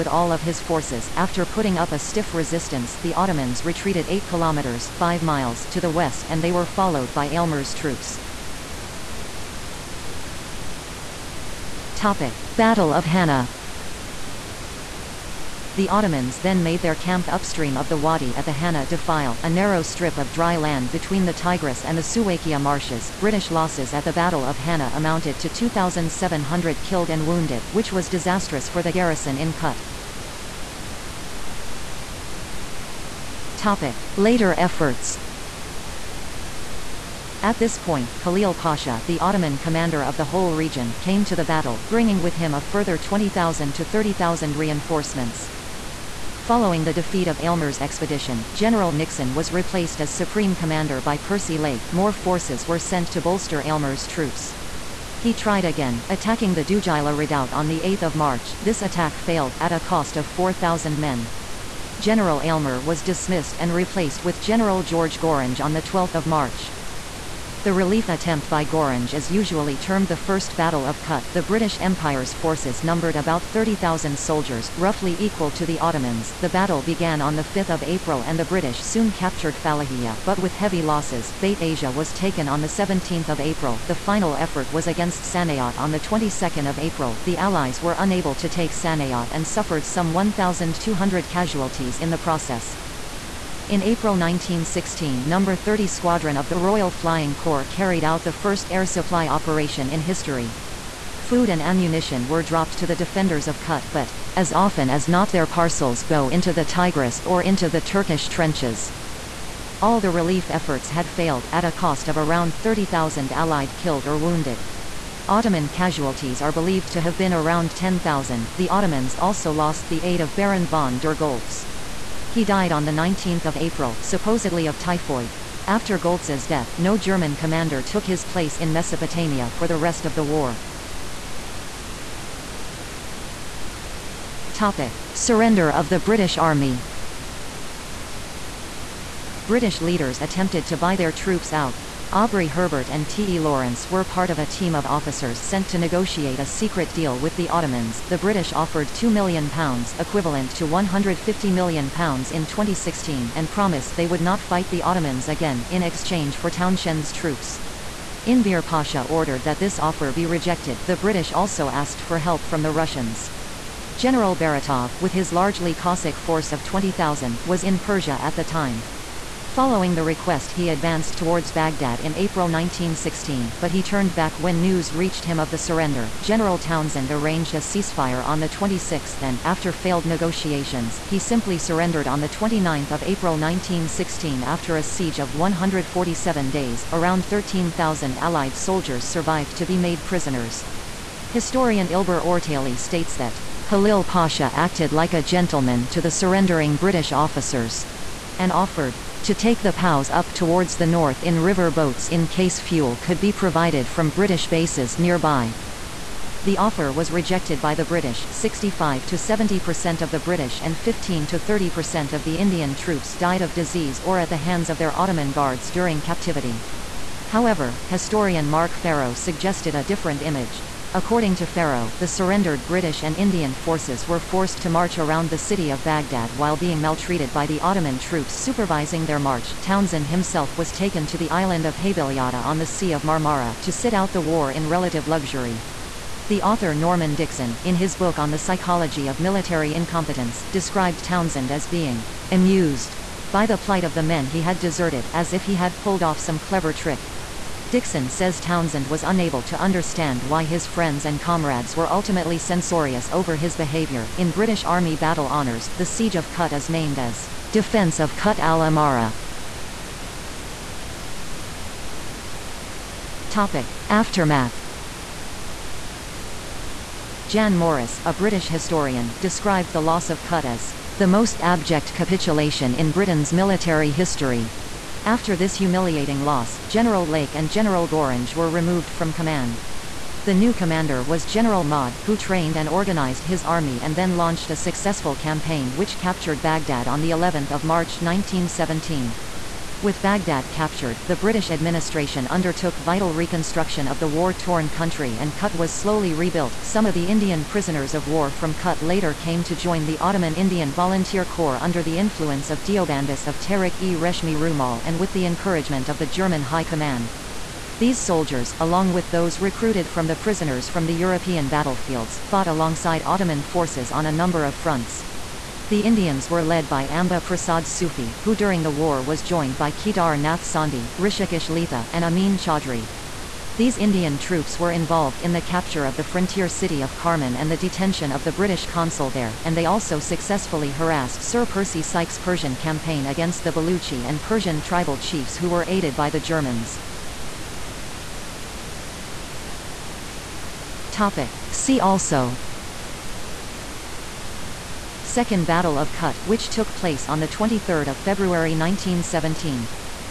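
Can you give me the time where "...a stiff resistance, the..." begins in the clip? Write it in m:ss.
0:01.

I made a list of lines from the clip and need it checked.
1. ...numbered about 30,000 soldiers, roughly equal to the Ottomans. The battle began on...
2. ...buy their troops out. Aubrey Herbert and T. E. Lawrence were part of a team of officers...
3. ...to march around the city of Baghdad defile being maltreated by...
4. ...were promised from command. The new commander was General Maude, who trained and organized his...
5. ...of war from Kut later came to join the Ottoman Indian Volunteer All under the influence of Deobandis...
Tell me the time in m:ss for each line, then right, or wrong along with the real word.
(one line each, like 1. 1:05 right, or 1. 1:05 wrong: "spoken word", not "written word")
1. 1:12 right
2. 2:20 right
3. 3:44 wrong: "while", not "defile"
4. 4:38 wrong: "removed", not "promised"
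5. 4:57 wrong: "Corps", not "All".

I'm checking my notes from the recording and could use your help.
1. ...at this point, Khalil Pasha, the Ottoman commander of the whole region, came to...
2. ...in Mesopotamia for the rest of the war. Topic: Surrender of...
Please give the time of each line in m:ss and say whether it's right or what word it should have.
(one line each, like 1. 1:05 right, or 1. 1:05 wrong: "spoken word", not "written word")
1. 0:37 right
2. 2:08 right.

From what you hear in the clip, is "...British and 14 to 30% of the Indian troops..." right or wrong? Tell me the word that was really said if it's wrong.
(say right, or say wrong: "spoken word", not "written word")
wrong: "15", not "14".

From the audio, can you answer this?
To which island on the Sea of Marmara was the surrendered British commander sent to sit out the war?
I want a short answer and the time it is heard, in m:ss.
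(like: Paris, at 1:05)
Heybeliada, at 3:51.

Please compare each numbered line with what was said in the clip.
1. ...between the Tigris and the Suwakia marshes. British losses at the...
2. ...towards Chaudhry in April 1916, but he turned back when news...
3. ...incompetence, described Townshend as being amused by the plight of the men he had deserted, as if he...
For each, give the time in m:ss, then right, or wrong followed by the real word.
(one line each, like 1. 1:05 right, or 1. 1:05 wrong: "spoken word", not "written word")
1. 0:20 right
2. 2:51 wrong: "Baghdad", not "Chaudhry"
3. 3:59 right.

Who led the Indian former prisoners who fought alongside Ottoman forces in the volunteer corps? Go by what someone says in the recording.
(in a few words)
Amba Prasad Sufi.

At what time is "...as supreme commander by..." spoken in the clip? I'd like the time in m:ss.
0:49.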